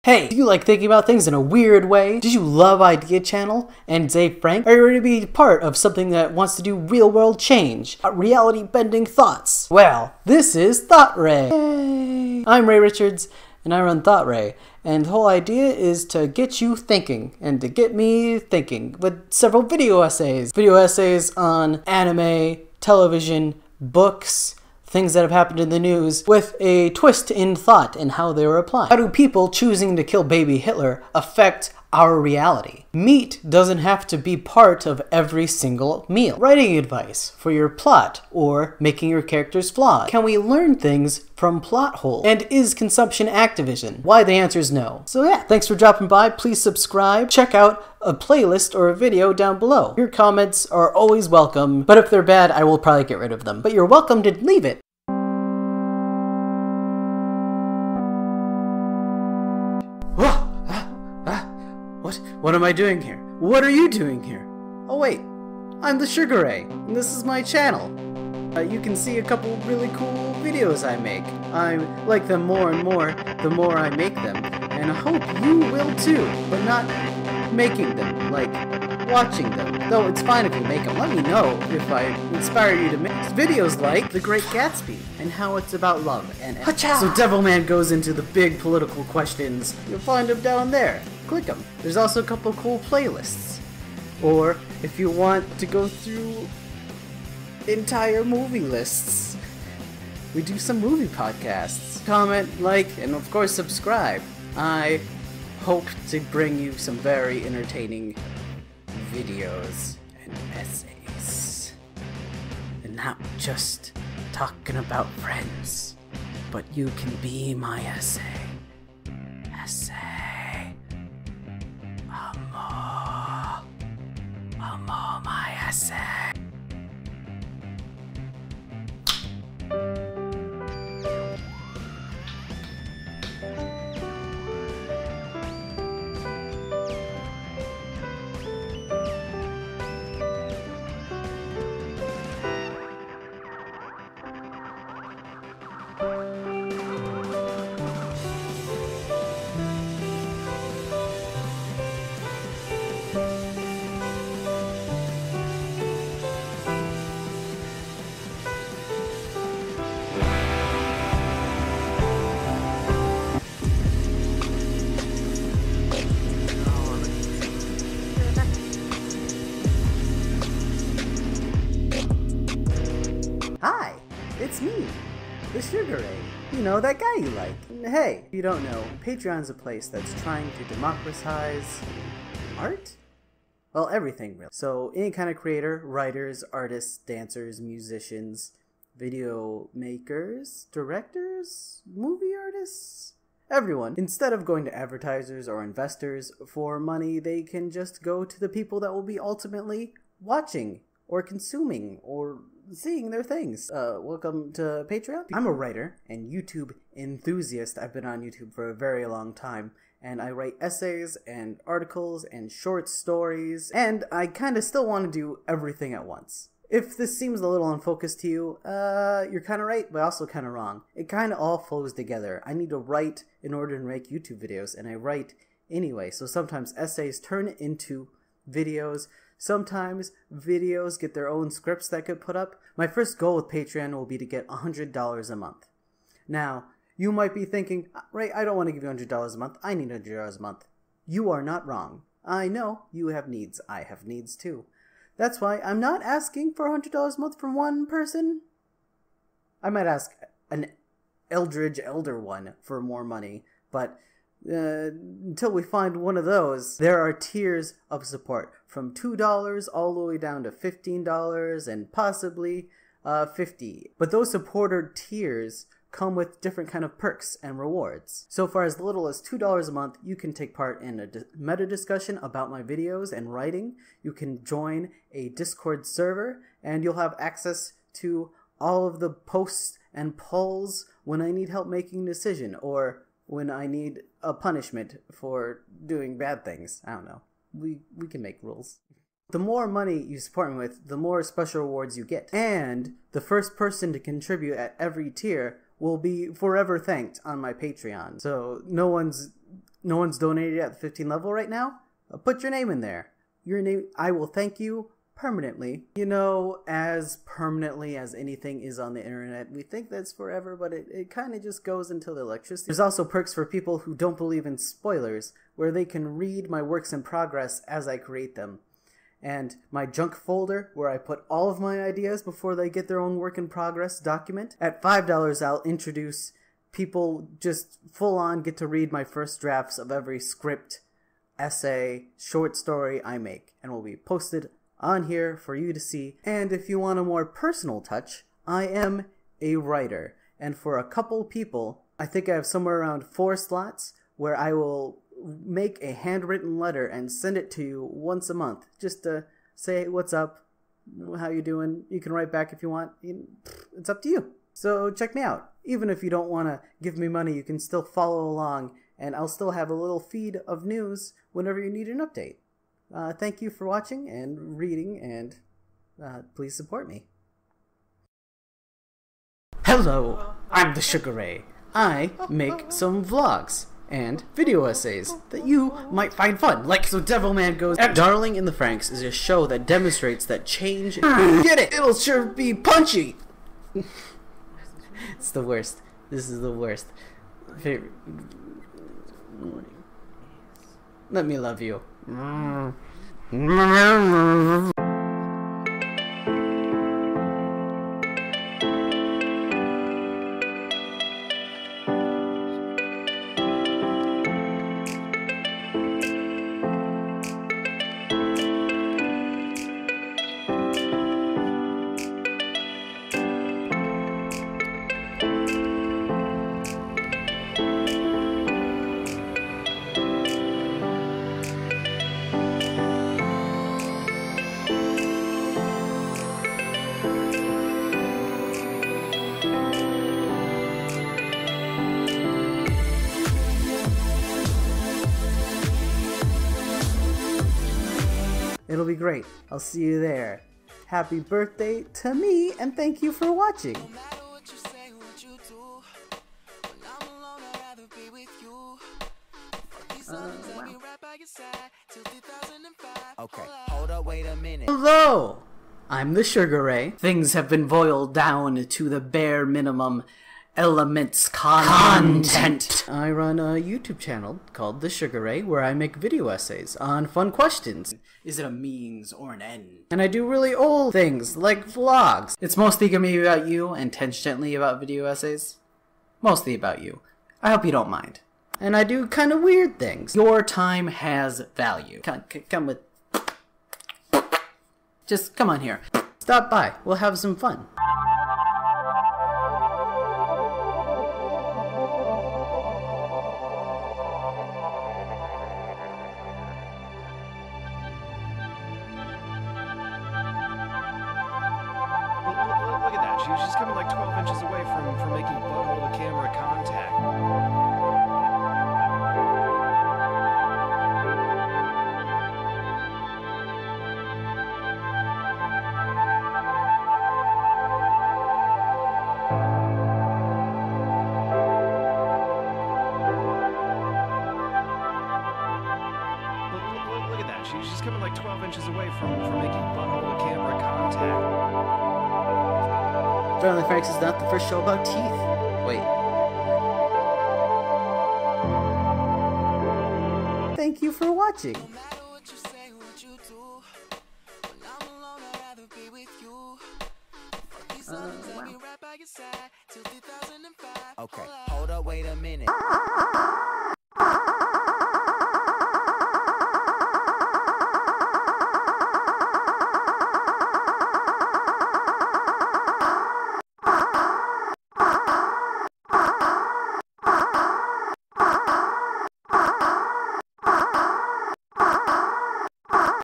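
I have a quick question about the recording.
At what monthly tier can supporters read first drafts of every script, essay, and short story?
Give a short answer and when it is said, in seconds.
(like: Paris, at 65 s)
$5, at 324 s.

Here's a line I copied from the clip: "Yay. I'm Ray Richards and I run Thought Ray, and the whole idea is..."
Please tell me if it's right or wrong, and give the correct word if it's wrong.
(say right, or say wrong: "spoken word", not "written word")
right.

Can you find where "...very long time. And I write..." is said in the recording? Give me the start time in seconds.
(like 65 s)
208 s.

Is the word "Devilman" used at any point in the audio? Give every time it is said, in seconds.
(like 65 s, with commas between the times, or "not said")
86 s, 376 s.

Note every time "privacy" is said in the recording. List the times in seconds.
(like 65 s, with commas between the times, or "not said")
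not said.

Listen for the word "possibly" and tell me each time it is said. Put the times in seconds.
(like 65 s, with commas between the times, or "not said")
261 s.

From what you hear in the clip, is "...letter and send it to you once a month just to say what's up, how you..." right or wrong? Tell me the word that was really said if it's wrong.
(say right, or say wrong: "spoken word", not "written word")
right.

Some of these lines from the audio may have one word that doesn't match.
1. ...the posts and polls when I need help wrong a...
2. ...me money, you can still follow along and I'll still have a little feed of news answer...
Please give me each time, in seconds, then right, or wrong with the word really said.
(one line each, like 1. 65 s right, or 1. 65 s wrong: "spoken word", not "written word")
1. 278 s wrong: "making", not "wrong"
2. 356 s wrong: "whenever", not "answer".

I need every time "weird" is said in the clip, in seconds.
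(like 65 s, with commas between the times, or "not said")
1 s, 479 s.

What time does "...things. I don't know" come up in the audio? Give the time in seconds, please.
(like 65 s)
286 s.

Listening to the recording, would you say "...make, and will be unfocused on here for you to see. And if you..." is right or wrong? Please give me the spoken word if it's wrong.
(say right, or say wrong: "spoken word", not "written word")
wrong: "posted", not "unfocused".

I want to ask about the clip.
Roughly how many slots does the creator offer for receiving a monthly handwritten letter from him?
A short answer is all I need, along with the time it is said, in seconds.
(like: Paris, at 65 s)
4, at 343 s.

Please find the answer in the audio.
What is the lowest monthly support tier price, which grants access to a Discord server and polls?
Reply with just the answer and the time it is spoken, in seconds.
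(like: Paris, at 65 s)
$2, at 269 s.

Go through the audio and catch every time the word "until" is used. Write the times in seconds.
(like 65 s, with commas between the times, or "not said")
255 s, 311 s.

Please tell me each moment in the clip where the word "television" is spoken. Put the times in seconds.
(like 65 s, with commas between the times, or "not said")
22 s.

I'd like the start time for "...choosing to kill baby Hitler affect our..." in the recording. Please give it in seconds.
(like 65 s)
29 s.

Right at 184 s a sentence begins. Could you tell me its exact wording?
So any kind of creator, writers, artists, dancers, musicians, video makers, directors, movie artists, everyone.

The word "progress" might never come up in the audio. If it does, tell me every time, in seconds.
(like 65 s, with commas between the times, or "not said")
317 s, 323 s.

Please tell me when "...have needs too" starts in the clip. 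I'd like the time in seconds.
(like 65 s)
243 s.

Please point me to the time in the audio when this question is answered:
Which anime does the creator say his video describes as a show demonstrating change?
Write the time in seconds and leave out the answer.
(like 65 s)
377 s.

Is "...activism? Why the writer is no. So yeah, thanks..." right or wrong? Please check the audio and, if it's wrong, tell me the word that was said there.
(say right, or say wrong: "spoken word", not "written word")
wrong: "answer", not "writer".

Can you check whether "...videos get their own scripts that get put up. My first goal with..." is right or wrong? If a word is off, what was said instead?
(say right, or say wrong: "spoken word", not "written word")
right.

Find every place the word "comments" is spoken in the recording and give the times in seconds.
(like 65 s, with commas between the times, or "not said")
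50 s, 102 s.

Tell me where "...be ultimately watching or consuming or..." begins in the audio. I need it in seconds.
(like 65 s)
199 s.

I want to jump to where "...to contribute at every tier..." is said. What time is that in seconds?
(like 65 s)
293 s.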